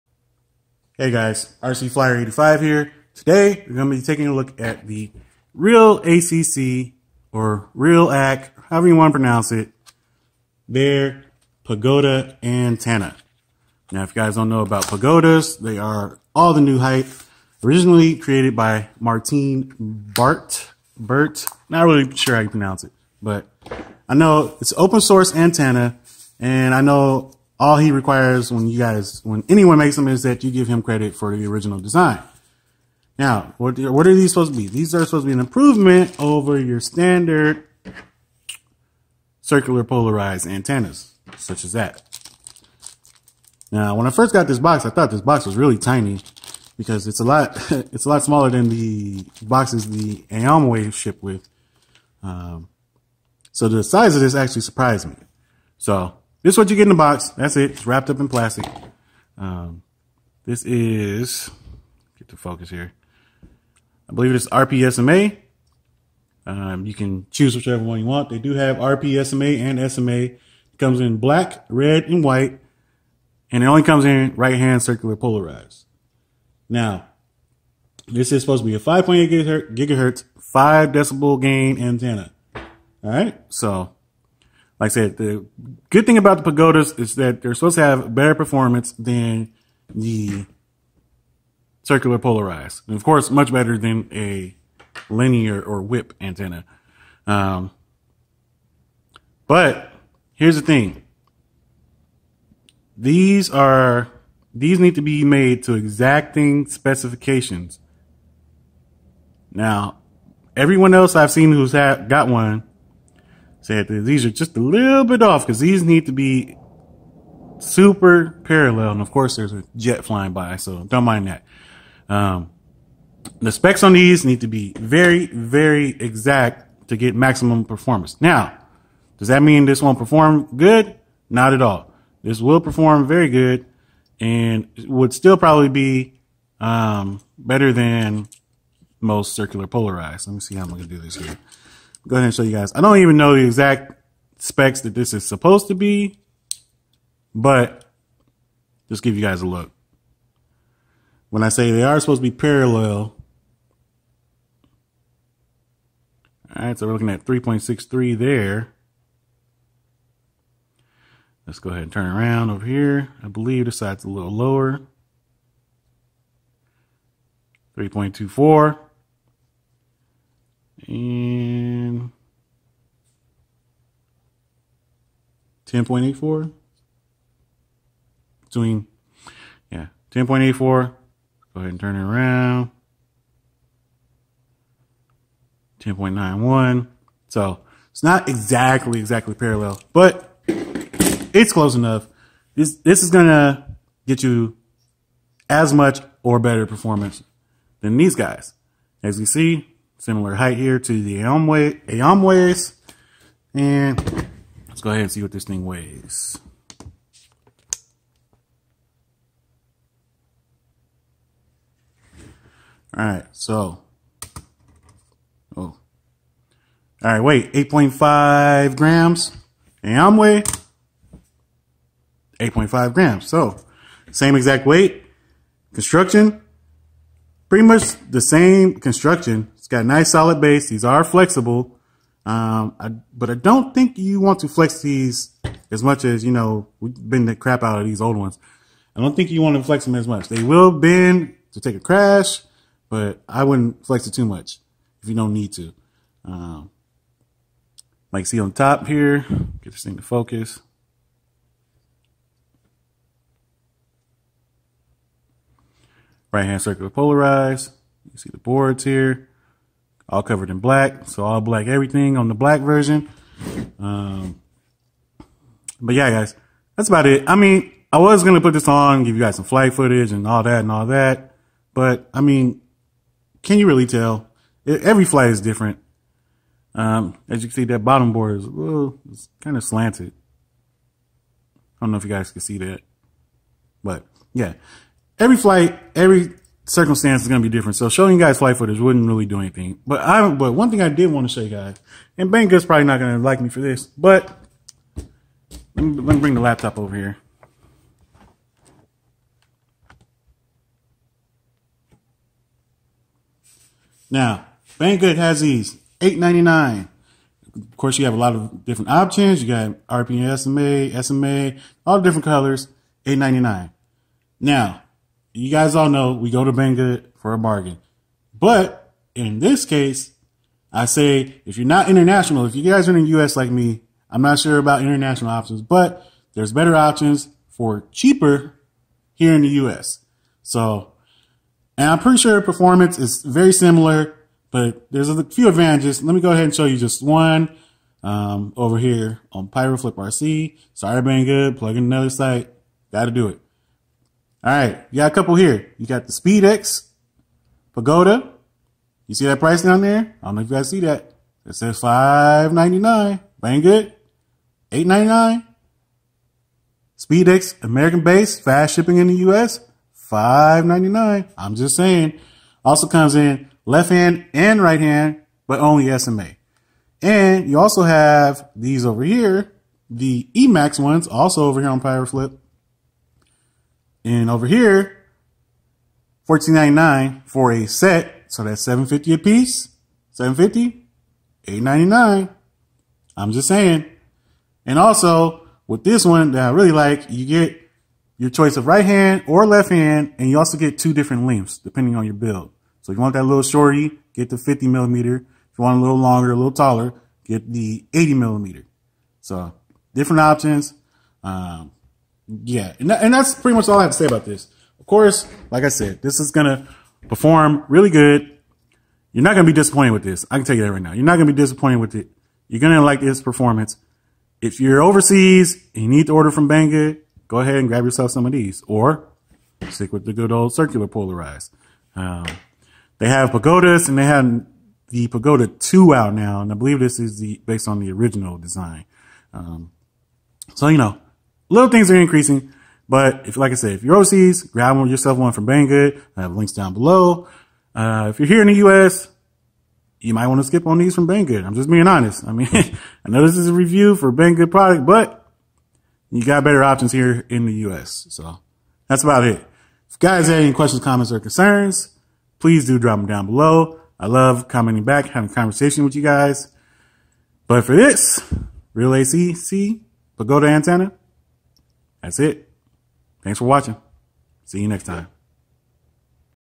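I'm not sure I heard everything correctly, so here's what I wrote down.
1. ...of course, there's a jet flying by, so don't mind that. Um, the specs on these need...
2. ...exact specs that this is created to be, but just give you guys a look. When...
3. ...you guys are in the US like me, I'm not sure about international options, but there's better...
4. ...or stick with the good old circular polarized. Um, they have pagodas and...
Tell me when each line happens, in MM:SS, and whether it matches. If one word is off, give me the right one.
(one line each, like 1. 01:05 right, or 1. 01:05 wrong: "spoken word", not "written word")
1. 01:59 right
2. 02:23 wrong: "supposed", not "created"
3. 05:22 right
4. 06:58 right.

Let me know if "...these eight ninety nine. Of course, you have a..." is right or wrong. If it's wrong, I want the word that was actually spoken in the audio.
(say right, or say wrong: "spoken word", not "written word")
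right.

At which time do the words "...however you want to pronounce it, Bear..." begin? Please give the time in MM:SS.
00:08.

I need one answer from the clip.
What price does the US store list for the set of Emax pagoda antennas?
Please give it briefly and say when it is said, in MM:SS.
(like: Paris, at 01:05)
$14.99, at 06:16.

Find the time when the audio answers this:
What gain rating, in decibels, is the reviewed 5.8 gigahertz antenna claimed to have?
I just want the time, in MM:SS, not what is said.
01:20.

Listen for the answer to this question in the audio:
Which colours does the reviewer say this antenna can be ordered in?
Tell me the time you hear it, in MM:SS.
01:11.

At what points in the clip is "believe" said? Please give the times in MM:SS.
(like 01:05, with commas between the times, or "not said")
01:04, 02:43, 07:06.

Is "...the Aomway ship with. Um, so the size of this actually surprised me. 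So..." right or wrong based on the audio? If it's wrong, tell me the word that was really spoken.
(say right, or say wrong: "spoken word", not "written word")
right.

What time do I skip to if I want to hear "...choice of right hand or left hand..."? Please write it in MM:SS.
06:28.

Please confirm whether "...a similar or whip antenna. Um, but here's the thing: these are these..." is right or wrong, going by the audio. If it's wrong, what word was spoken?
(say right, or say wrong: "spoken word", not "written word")
wrong: "linear", not "similar".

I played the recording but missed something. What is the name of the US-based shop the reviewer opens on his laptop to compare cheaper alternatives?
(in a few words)
PyroFlip RC.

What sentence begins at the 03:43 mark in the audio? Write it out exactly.
So, same exact weight, construction, pretty much the same construction.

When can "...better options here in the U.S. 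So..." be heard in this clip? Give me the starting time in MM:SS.
07:26.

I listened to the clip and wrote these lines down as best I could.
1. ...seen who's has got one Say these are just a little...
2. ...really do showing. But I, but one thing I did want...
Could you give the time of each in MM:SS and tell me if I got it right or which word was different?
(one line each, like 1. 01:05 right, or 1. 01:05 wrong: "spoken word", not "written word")
1. 01:51 right
2. 04:49 wrong: "anything", not "showing".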